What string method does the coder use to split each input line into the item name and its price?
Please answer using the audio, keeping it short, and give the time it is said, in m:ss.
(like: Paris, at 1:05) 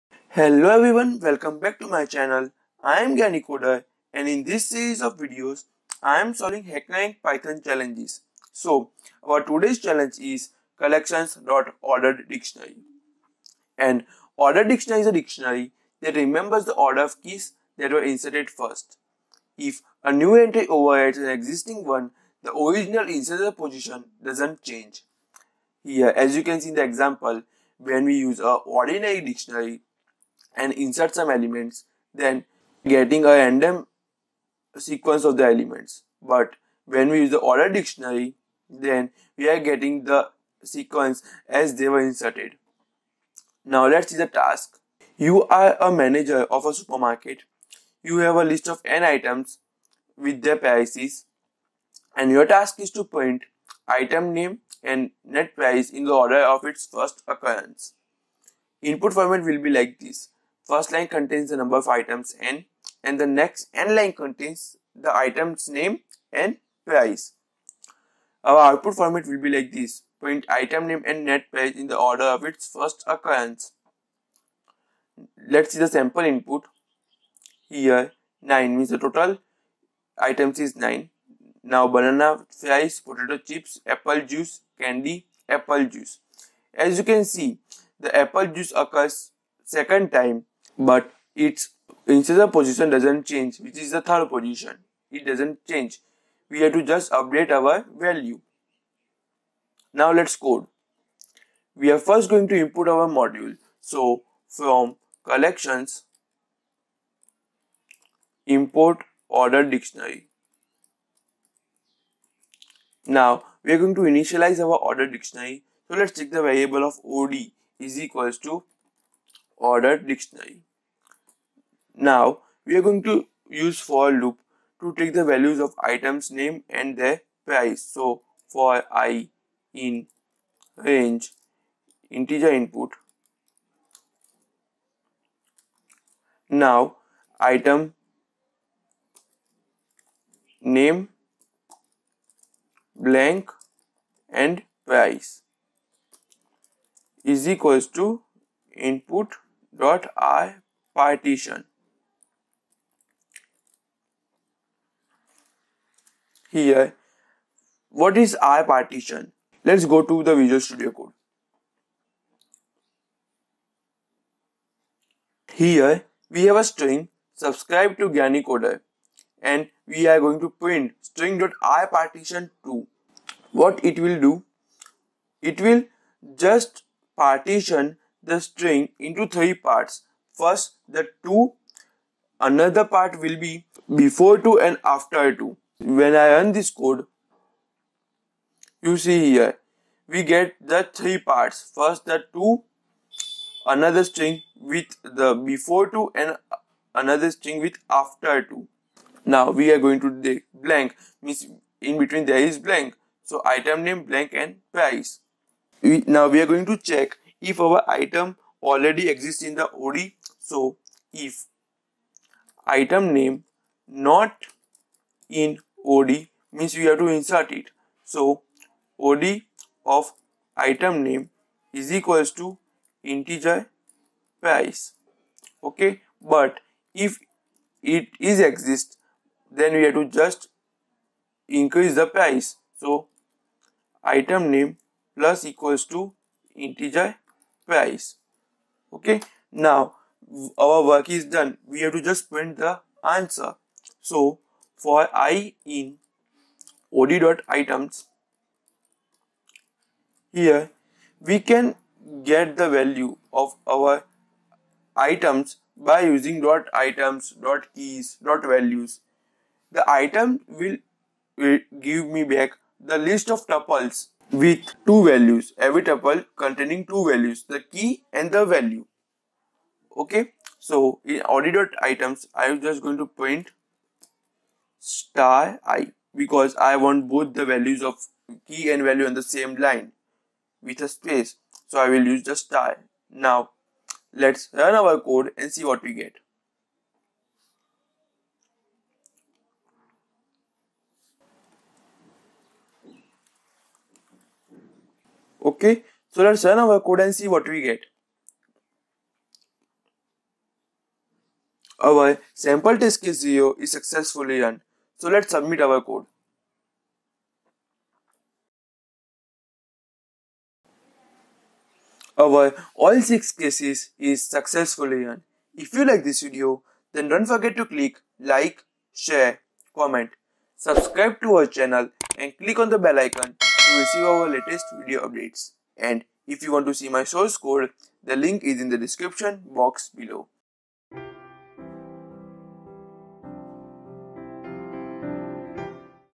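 rpartition, at 2:38.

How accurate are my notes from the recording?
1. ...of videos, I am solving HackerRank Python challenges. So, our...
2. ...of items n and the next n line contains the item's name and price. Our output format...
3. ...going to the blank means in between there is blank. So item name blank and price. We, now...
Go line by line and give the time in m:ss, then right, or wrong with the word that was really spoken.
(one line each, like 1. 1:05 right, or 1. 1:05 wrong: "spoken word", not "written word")
1. 0:05 right
2. 1:01 right
3. 3:19 right.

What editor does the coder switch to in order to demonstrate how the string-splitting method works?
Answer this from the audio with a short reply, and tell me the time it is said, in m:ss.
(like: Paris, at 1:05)
Visual Studio Code, at 2:40.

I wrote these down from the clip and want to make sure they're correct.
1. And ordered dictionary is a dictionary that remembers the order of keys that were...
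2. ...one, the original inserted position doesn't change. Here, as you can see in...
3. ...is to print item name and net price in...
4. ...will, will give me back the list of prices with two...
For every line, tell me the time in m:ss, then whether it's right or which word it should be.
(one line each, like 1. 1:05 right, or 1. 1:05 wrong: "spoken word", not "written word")
1. 0:13 right
2. 0:21 right
3. 0:52 right
4. 4:20 wrong: "tuples", not "prices".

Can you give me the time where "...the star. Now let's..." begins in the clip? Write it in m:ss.
4:42.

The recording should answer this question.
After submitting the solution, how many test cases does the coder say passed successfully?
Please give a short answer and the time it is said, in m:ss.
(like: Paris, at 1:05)
6, at 5:13.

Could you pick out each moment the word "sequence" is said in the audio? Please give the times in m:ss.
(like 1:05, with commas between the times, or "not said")
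0:34, 0:40.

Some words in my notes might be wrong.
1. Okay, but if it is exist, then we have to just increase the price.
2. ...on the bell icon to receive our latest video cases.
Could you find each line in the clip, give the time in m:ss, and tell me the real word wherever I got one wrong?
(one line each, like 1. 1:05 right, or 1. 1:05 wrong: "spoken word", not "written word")
1. 3:45 right
2. 5:22 wrong: "updates", not "cases".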